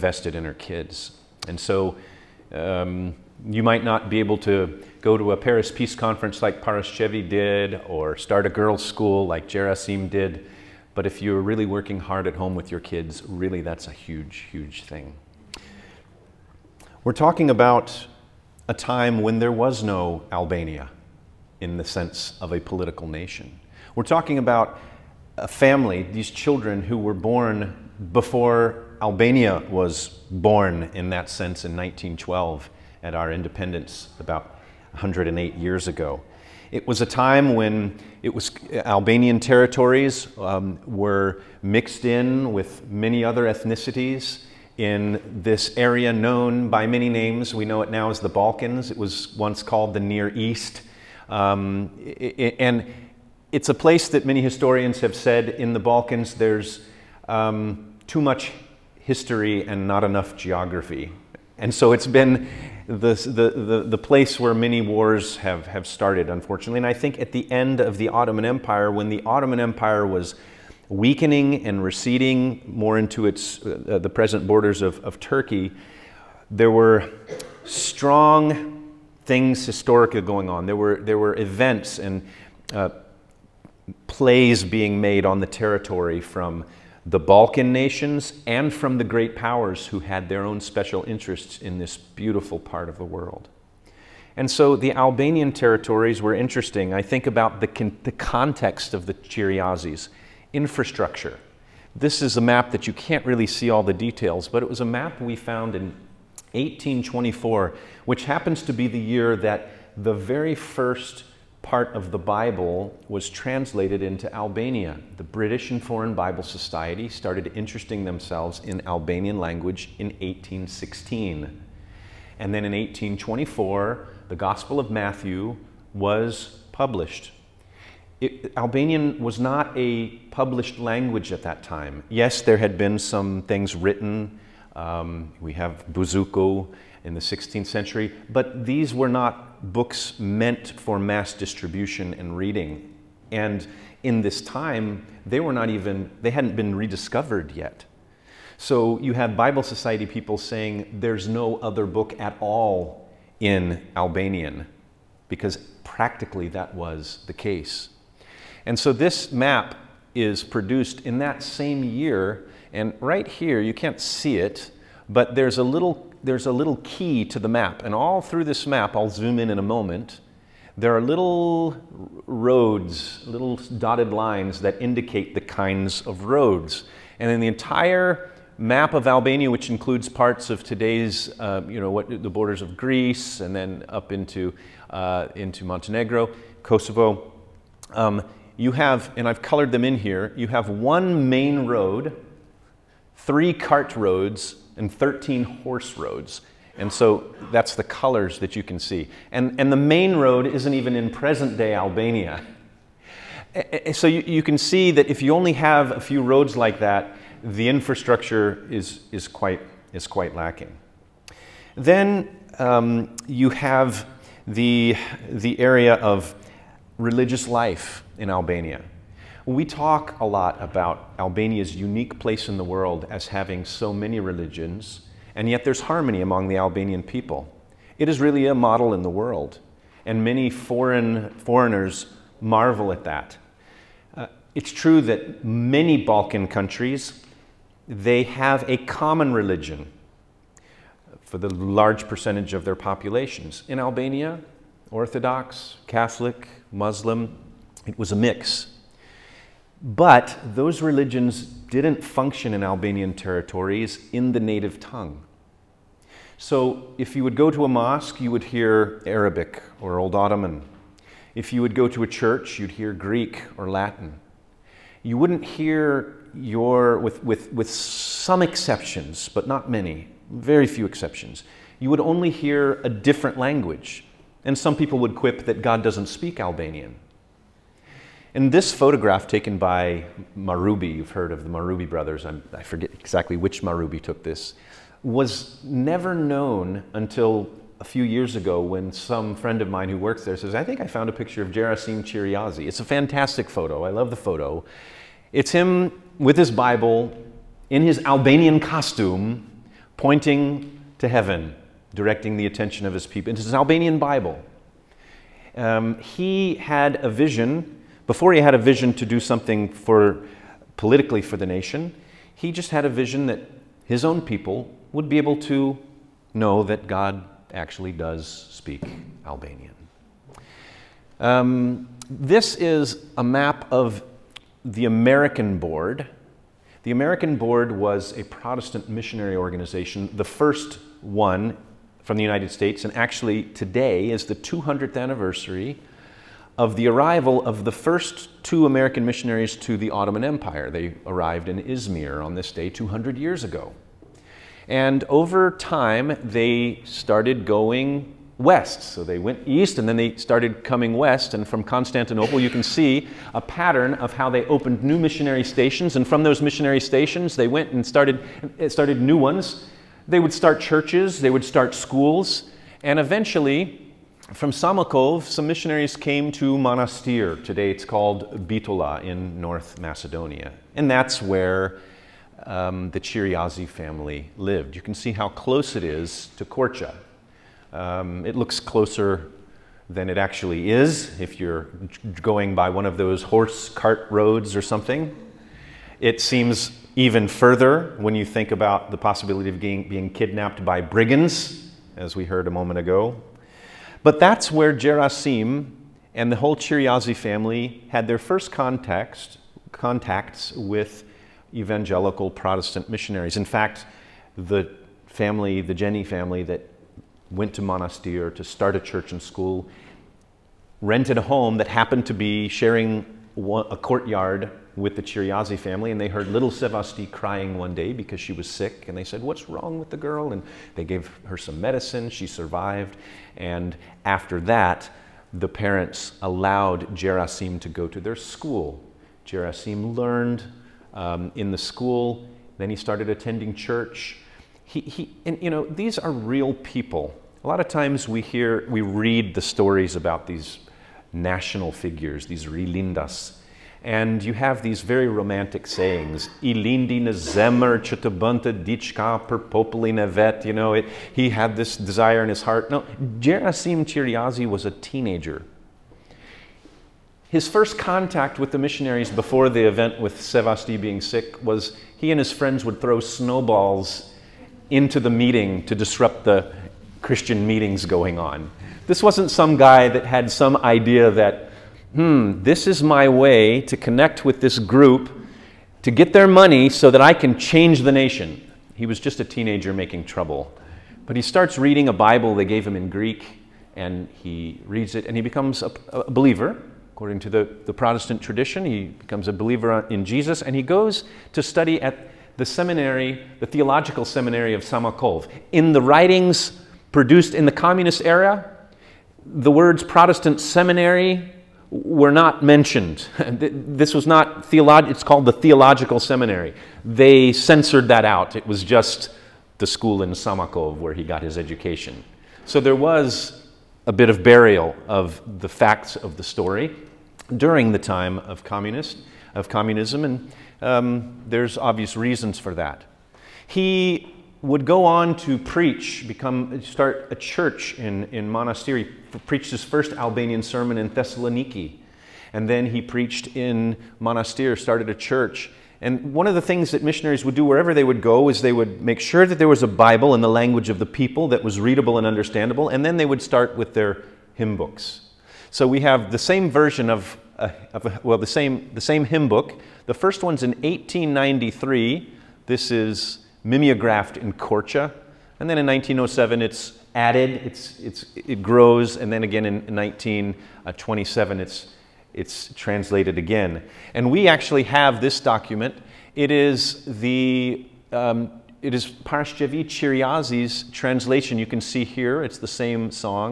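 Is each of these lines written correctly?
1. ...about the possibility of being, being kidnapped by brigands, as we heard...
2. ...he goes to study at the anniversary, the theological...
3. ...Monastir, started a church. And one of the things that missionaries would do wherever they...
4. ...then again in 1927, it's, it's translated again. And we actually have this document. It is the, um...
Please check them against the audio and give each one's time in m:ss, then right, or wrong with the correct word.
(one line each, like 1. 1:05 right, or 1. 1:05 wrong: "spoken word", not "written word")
1. 6:28 right
2. 8:10 wrong: "seminary", not "anniversary"
3. 8:54 right
4. 9:19 right.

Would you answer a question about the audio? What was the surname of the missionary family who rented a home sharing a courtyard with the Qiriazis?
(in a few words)
Jenny.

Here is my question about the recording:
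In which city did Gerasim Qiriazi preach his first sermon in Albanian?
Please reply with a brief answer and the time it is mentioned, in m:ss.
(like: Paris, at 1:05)
Thessaloniki, at 8:50.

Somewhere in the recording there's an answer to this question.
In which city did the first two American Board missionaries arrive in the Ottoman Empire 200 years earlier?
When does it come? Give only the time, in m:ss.
5:41.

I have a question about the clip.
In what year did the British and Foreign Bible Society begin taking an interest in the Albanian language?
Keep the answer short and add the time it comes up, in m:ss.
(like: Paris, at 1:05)
1816, at 2:00.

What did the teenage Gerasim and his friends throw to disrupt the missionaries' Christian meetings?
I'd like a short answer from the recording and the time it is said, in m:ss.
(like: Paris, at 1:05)
Snowballs, at 7:42.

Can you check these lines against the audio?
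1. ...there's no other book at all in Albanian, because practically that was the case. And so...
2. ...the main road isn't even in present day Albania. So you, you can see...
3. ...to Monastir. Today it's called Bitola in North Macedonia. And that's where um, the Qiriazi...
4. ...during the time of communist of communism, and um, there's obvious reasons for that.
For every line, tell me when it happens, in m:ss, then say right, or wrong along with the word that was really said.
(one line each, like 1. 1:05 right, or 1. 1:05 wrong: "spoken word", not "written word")
1. 2:30 right
2. 3:19 right
3. 6:06 right
4. 8:37 right.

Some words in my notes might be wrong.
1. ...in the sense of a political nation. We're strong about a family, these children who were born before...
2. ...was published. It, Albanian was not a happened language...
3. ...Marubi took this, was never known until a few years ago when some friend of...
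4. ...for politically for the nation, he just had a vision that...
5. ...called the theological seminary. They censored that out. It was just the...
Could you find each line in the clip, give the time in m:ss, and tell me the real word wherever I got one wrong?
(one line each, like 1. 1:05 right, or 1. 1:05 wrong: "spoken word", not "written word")
1. 0:21 wrong: "talking", not "strong"
2. 2:05 wrong: "published", not "happened"
3. 4:43 right
4. 5:09 right
5. 8:25 right.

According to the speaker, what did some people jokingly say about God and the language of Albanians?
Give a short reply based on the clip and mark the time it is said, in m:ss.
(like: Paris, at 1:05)
God doesn't speak Albanian, at 4:35.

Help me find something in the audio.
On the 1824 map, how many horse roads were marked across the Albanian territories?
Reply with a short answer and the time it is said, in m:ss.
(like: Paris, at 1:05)
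13, at 3:14.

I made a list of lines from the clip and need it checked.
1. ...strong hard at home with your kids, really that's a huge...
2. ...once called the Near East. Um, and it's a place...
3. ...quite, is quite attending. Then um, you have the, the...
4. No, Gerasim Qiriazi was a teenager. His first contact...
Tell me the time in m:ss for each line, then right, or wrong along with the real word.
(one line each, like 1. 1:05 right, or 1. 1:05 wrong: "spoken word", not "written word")
1. 0:11 wrong: "working", not "strong"
2. 0:49 right
3. 3:29 wrong: "lacking", not "attending"
4. 7:32 right.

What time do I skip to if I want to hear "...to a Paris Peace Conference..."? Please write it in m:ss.
0:05.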